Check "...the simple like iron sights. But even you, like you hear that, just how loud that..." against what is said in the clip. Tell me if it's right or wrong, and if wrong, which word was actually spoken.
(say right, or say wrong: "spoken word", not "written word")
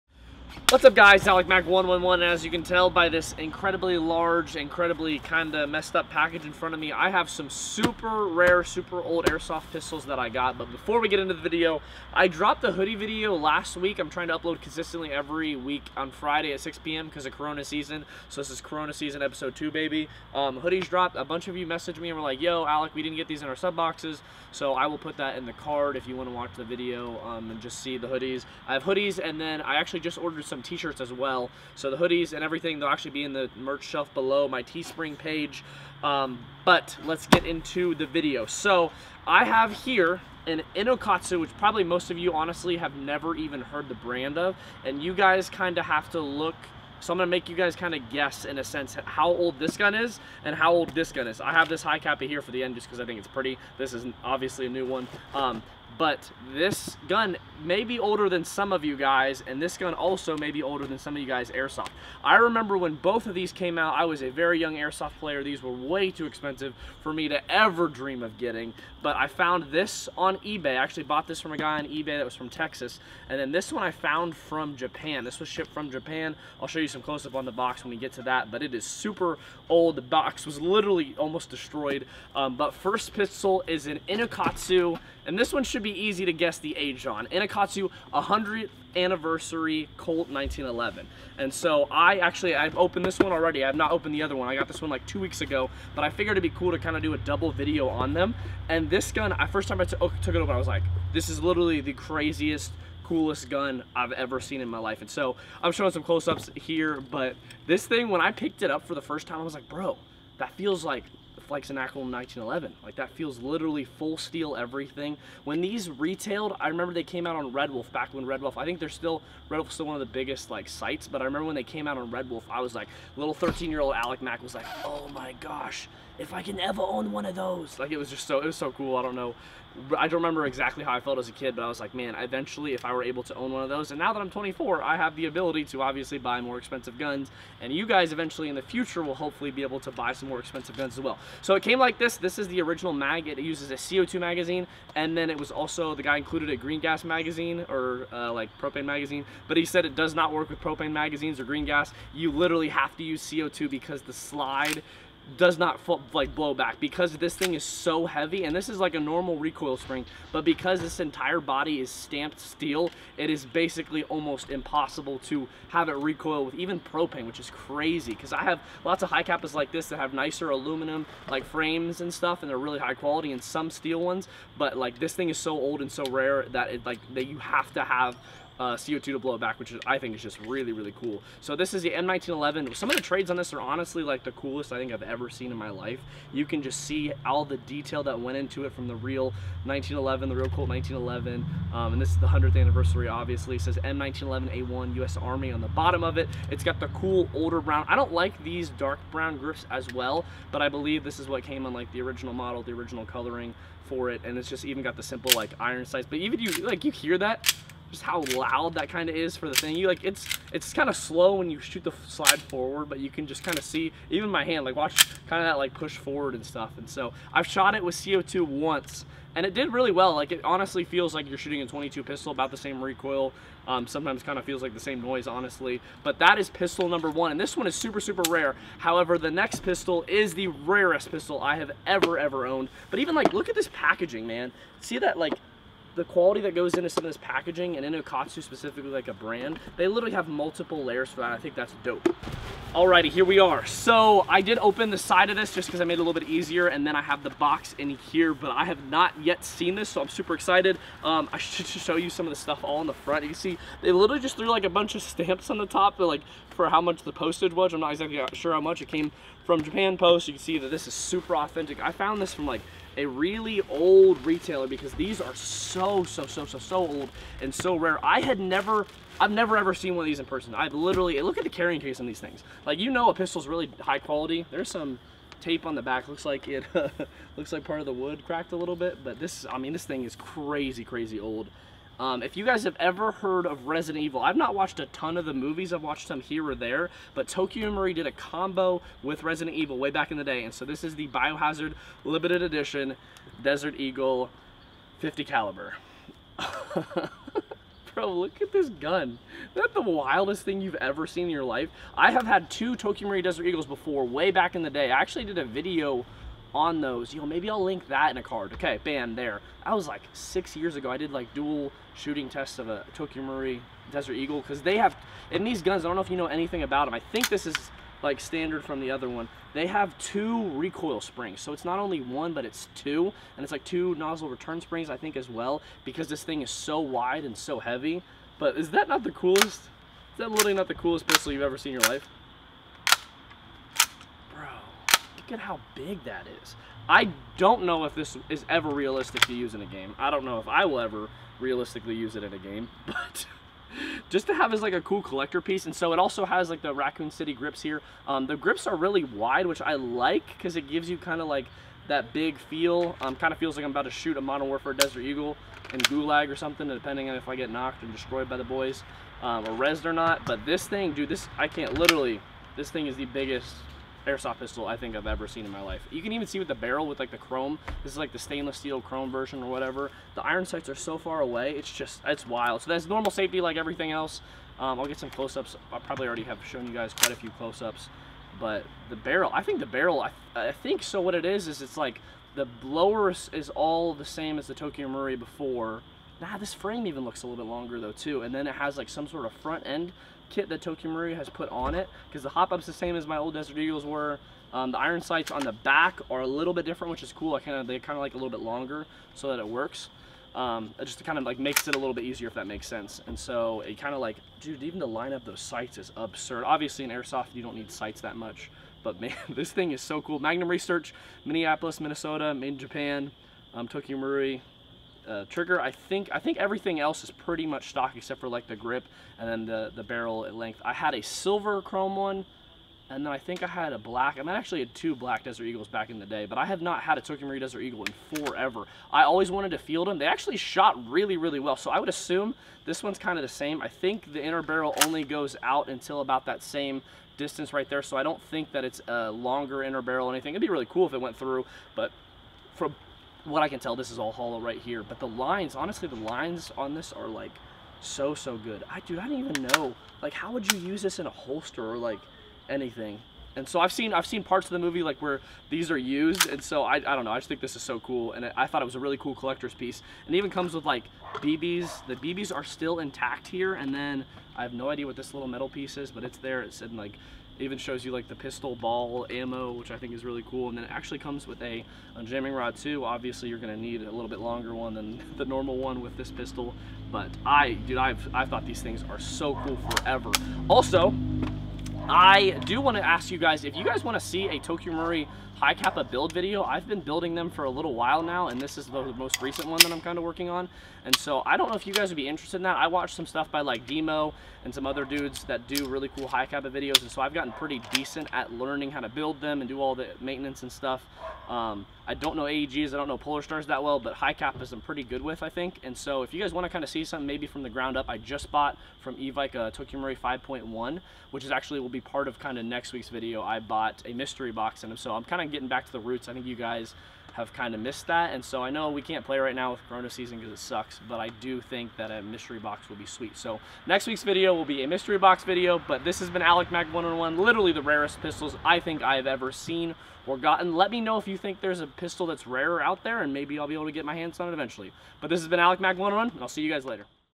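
right.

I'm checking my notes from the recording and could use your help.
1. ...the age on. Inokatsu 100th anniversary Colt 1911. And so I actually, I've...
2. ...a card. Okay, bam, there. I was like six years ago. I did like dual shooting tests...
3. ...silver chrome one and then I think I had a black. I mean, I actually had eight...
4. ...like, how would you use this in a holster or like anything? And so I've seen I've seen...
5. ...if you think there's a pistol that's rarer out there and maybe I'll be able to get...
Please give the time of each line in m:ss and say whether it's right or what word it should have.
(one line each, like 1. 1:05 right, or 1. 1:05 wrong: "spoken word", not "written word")
1. 1:26 right
2. 5:08 right
3. 7:01 wrong: "two", not "eight"
4. 7:30 right
5. 8:50 right.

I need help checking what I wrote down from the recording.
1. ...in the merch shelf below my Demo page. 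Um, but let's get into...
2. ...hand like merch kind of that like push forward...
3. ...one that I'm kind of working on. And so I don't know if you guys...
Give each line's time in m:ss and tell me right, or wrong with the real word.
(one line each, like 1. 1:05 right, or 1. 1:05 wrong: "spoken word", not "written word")
1. 0:33 wrong: "Teespring", not "Demo"
2. 3:34 wrong: "watch", not "merch"
3. 8:09 right.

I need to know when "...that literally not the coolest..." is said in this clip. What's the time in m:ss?
5:30.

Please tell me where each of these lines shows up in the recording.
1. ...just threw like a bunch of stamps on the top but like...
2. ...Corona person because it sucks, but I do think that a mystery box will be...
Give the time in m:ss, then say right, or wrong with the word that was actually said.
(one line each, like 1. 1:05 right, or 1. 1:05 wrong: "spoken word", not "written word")
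1. 4:14 right
2. 8:39 wrong: "season", not "person".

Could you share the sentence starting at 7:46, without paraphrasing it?
It's in like even shows you like the pistol ball ammo, which I think is really cool.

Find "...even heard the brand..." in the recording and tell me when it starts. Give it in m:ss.
0:43.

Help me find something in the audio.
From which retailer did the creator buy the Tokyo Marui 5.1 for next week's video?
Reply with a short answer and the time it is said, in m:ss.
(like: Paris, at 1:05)
Evike, at 8:28.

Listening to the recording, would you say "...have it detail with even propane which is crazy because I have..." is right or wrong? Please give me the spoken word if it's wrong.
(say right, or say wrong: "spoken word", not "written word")
wrong: "recoil", not "detail".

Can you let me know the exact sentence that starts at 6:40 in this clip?
Um, it just kind of like makes it a little bit easier if that makes sense.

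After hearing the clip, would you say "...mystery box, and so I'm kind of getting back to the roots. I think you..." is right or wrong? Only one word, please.
right.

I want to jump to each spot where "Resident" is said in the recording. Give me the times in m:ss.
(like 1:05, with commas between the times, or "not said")
4:43, 4:49.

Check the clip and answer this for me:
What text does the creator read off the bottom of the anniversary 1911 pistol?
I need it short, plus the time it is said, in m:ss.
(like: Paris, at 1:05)
M1911A1 US Army, at 3:13.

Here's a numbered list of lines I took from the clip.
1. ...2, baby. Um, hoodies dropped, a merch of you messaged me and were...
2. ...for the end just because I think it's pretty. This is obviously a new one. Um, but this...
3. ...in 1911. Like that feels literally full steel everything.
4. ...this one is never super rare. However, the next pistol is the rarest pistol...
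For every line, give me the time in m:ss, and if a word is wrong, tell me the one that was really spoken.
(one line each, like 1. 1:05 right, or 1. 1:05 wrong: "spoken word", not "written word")
1. 0:19 wrong: "bunch", not "merch"
2. 0:52 right
3. 1:51 right
4. 3:47 wrong: "super", not "never".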